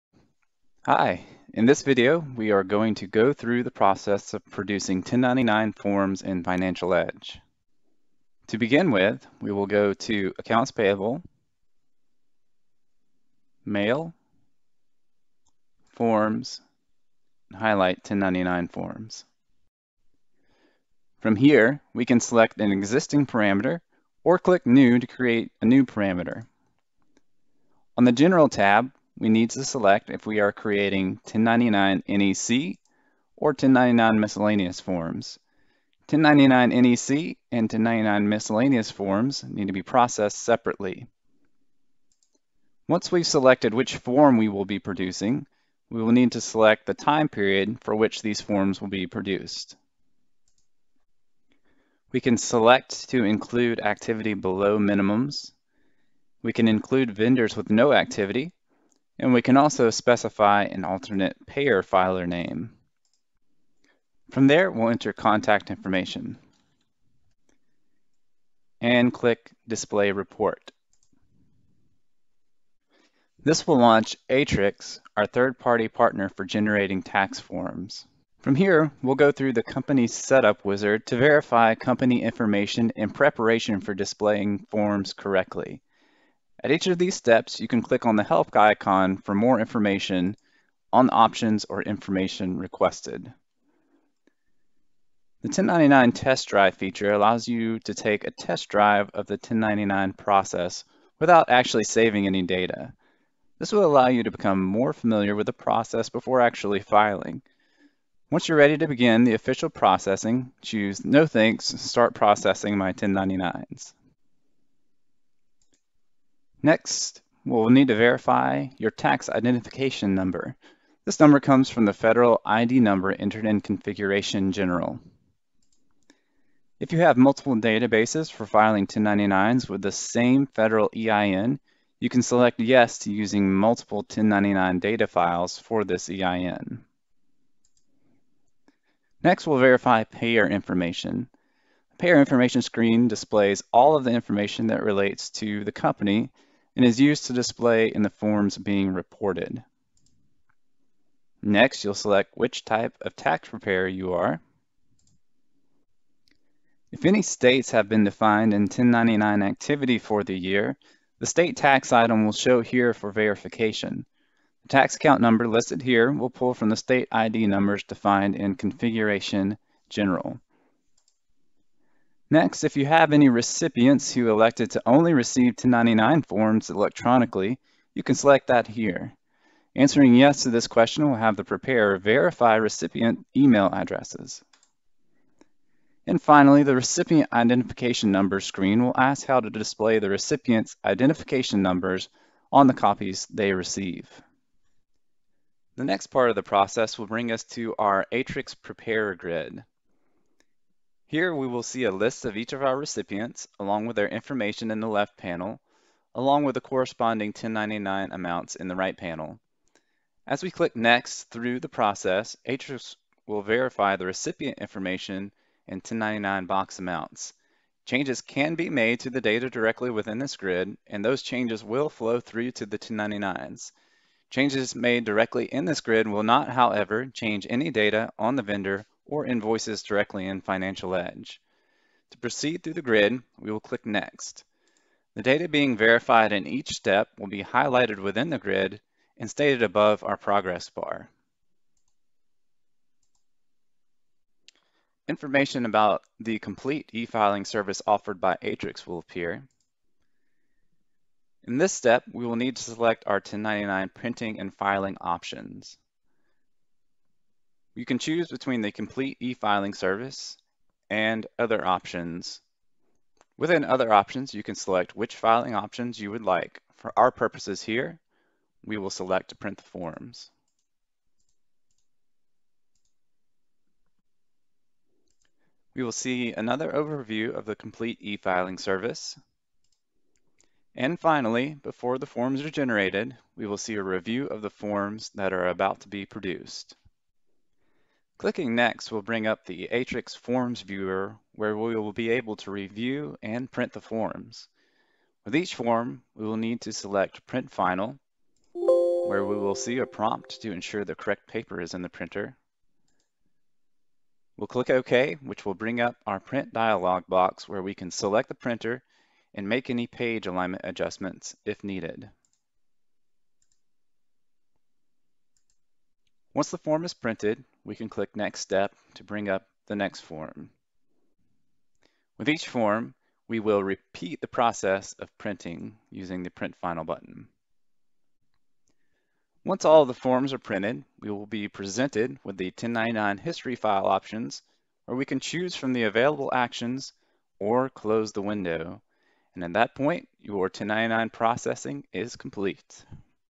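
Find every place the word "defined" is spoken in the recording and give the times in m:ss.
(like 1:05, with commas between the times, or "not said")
2:38, 2:47.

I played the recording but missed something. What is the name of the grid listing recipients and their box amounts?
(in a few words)
Aatrix Preparer Grid.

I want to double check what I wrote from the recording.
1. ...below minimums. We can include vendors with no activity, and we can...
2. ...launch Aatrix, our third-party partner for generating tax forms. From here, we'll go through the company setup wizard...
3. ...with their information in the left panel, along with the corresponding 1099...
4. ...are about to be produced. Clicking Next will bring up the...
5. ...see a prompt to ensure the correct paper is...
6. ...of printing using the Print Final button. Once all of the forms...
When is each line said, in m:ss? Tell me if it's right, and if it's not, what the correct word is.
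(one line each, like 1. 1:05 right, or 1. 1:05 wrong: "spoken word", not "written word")
1. 0:54 right
2. 1:13 right
3. 3:23 right
4. 4:45 right
5. 4:59 right
6. 5:24 right.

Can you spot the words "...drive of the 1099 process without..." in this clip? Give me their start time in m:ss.
1:38.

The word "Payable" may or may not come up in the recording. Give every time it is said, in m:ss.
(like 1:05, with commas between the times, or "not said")
0:10.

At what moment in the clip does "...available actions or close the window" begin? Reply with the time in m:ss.
5:35.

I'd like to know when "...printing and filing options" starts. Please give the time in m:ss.
4:13.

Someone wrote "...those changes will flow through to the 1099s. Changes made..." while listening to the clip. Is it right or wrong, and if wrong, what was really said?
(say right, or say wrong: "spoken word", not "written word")
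right.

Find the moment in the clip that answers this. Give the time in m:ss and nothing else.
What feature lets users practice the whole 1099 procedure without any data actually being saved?
1:35.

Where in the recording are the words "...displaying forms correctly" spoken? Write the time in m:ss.
1:23.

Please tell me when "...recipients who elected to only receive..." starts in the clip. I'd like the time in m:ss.
2:53.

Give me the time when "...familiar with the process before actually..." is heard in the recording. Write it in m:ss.
1:44.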